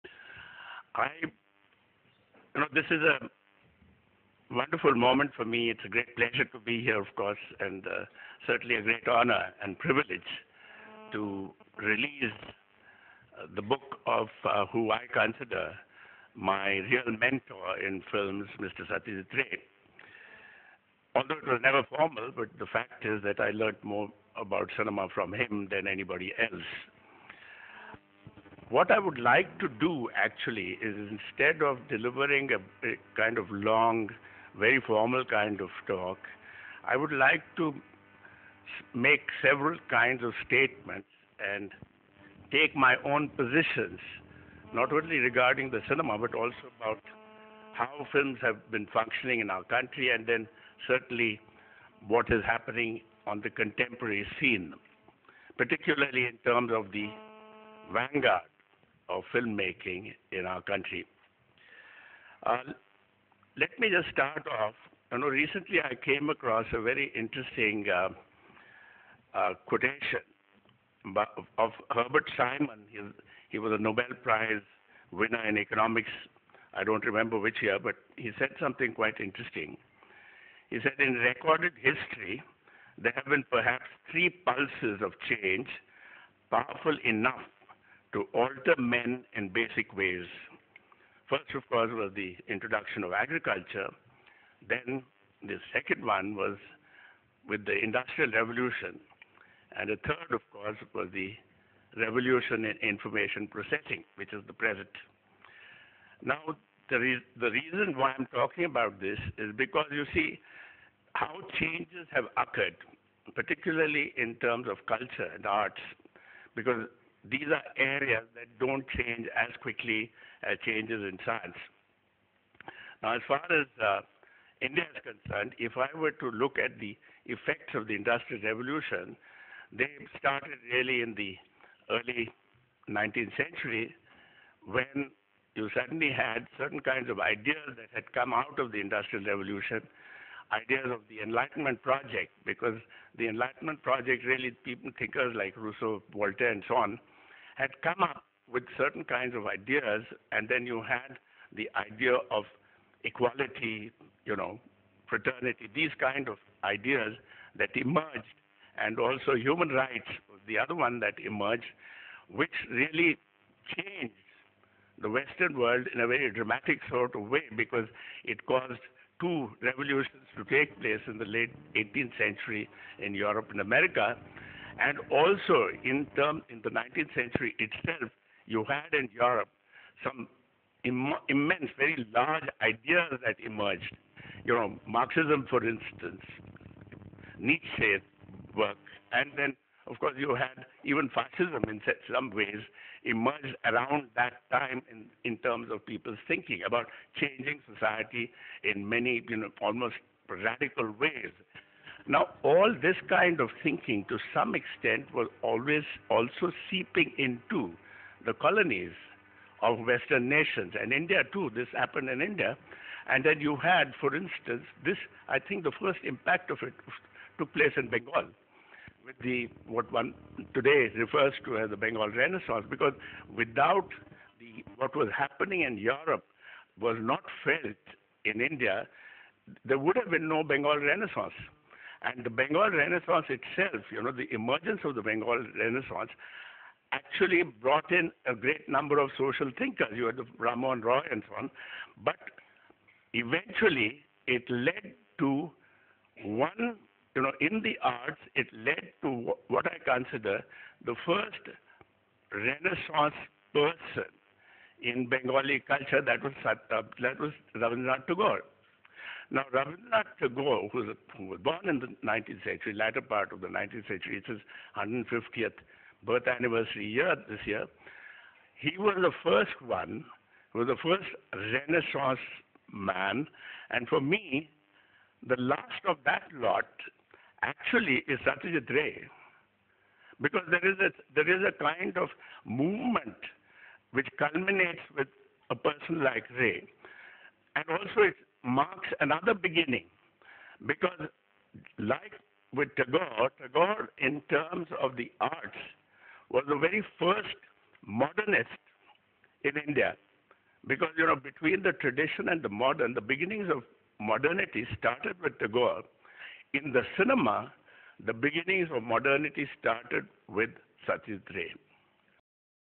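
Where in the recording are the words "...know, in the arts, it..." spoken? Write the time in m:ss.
4:07.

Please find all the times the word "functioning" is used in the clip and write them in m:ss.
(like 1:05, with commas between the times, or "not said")
0:48.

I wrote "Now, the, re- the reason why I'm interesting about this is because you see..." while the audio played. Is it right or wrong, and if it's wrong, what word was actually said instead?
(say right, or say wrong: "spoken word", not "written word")
wrong: "talking", not "interesting".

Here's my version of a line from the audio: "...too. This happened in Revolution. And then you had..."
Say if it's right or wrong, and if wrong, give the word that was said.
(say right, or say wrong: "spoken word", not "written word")
wrong: "India", not "Revolution".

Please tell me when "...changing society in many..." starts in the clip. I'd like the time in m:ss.
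3:17.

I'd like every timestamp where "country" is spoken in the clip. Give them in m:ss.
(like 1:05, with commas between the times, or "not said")
0:49, 1:00.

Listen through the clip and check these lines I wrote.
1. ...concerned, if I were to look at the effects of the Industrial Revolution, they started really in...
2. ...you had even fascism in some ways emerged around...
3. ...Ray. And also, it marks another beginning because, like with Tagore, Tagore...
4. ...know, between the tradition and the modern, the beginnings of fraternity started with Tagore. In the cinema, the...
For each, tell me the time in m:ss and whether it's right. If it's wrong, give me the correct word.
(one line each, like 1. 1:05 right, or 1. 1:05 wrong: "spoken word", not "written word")
1. 2:05 right
2. 3:10 right
3. 4:46 right
4. 5:01 wrong: "modernity", not "fraternity".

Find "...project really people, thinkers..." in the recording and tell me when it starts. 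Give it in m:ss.
2:23.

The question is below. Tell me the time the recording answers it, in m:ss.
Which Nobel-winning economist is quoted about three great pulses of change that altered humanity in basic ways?
1:11.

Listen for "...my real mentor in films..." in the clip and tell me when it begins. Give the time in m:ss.
0:16.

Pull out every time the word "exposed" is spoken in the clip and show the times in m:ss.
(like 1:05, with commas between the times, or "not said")
not said.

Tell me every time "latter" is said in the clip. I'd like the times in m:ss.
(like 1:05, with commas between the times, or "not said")
4:22.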